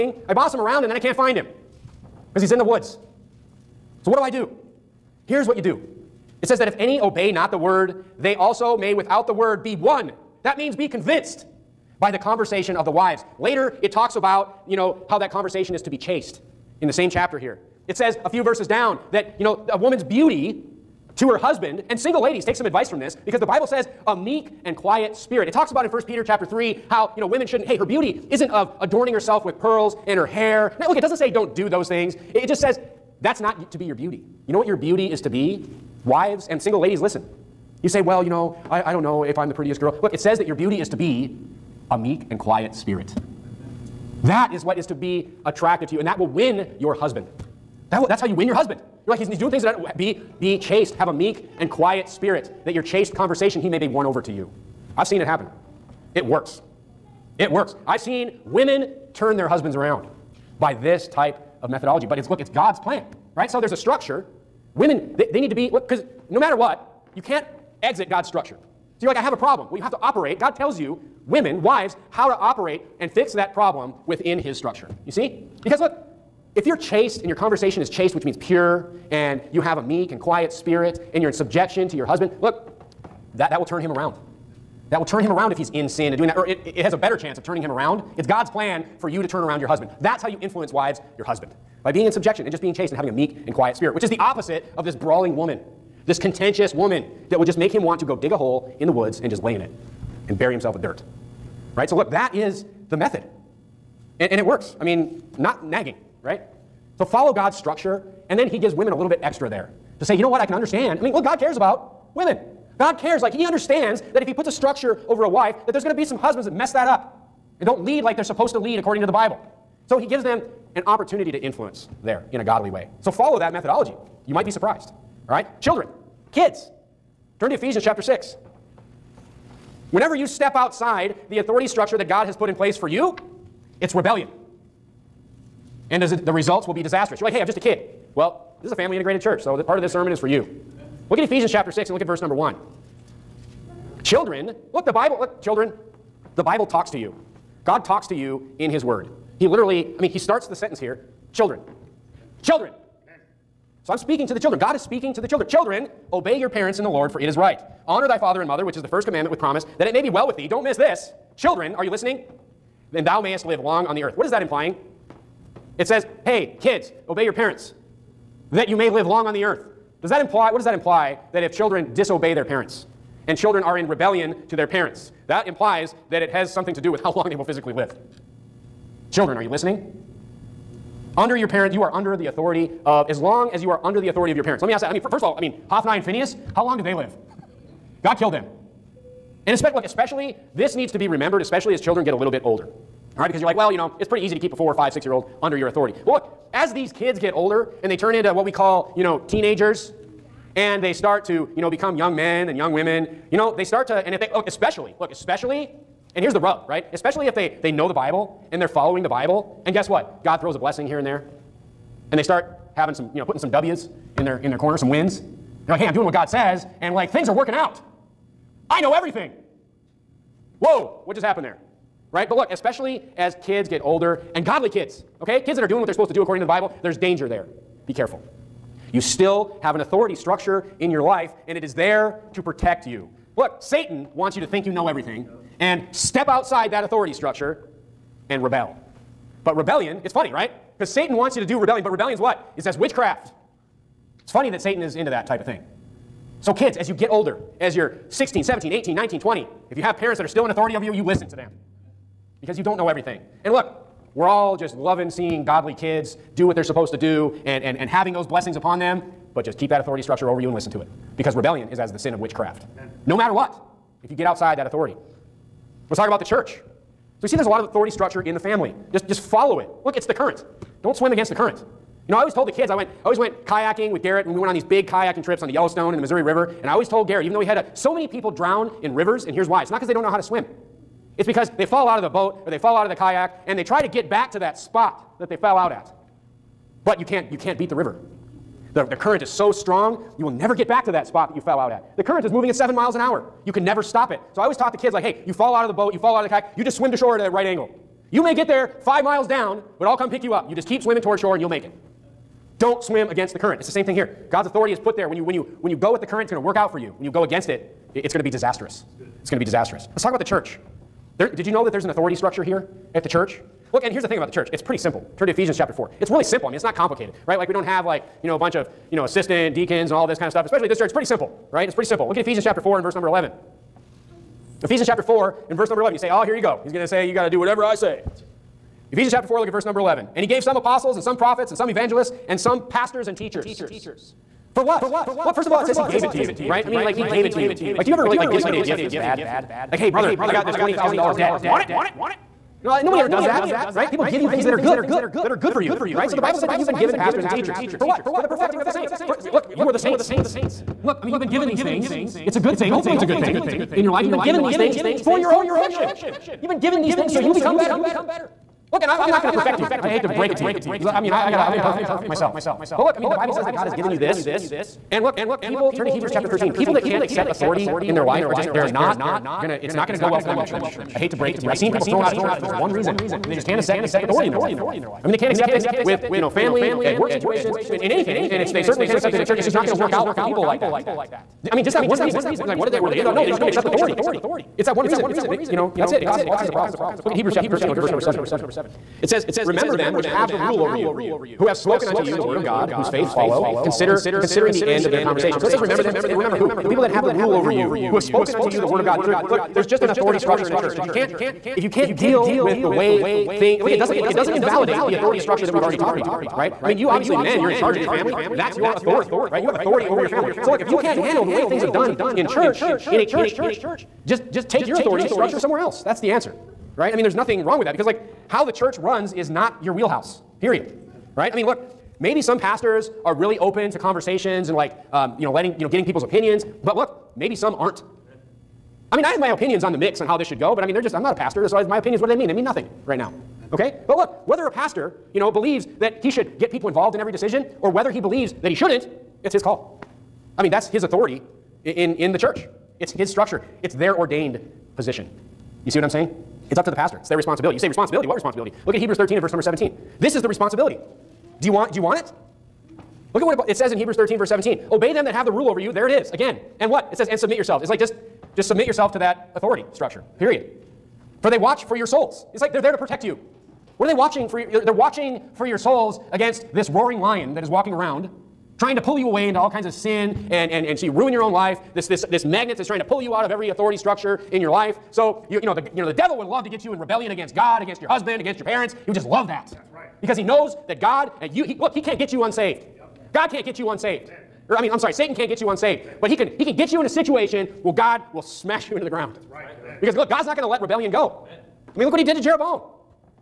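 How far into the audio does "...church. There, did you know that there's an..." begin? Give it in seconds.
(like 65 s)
310 s.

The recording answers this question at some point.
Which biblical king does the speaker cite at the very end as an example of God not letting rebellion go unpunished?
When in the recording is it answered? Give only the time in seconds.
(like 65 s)
492 s.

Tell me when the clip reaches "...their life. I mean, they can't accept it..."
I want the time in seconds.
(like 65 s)
374 s.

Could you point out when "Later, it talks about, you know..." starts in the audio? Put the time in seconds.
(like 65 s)
13 s.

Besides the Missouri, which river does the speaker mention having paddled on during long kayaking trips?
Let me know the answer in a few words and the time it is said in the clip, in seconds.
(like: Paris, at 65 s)
Yellowstone, at 275 s.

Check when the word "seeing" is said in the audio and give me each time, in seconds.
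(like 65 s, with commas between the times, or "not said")
255 s.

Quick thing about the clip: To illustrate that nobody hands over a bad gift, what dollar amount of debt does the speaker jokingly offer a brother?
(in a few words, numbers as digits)
$20,000.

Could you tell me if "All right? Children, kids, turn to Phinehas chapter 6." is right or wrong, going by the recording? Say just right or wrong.
wrong.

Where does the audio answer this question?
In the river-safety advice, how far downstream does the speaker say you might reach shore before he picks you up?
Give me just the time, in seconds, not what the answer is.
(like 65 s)
298 s.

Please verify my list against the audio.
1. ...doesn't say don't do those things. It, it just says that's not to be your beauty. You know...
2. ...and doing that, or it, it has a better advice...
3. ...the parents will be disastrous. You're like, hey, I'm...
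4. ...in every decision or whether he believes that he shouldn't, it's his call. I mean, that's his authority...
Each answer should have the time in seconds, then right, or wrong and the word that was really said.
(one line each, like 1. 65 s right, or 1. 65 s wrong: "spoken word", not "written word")
1. 31 s right
2. 86 s wrong: "chance", not "advice"
3. 136 s wrong: "results", not "parents"
4. 436 s right.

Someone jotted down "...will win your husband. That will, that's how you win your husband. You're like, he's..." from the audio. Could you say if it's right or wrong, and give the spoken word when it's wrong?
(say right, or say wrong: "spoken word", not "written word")
right.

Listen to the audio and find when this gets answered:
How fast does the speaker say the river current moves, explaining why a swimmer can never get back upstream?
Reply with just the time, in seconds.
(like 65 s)
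292 s.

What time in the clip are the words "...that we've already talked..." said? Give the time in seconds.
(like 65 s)
405 s.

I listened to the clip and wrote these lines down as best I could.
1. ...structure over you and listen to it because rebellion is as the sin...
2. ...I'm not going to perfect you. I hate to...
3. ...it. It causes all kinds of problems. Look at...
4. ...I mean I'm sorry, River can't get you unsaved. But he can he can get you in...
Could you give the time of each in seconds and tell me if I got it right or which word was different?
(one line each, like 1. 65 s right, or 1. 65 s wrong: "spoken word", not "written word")
1. 260 s right
2. 358 s right
3. 385 s right
4. 484 s wrong: "Satan", not "River".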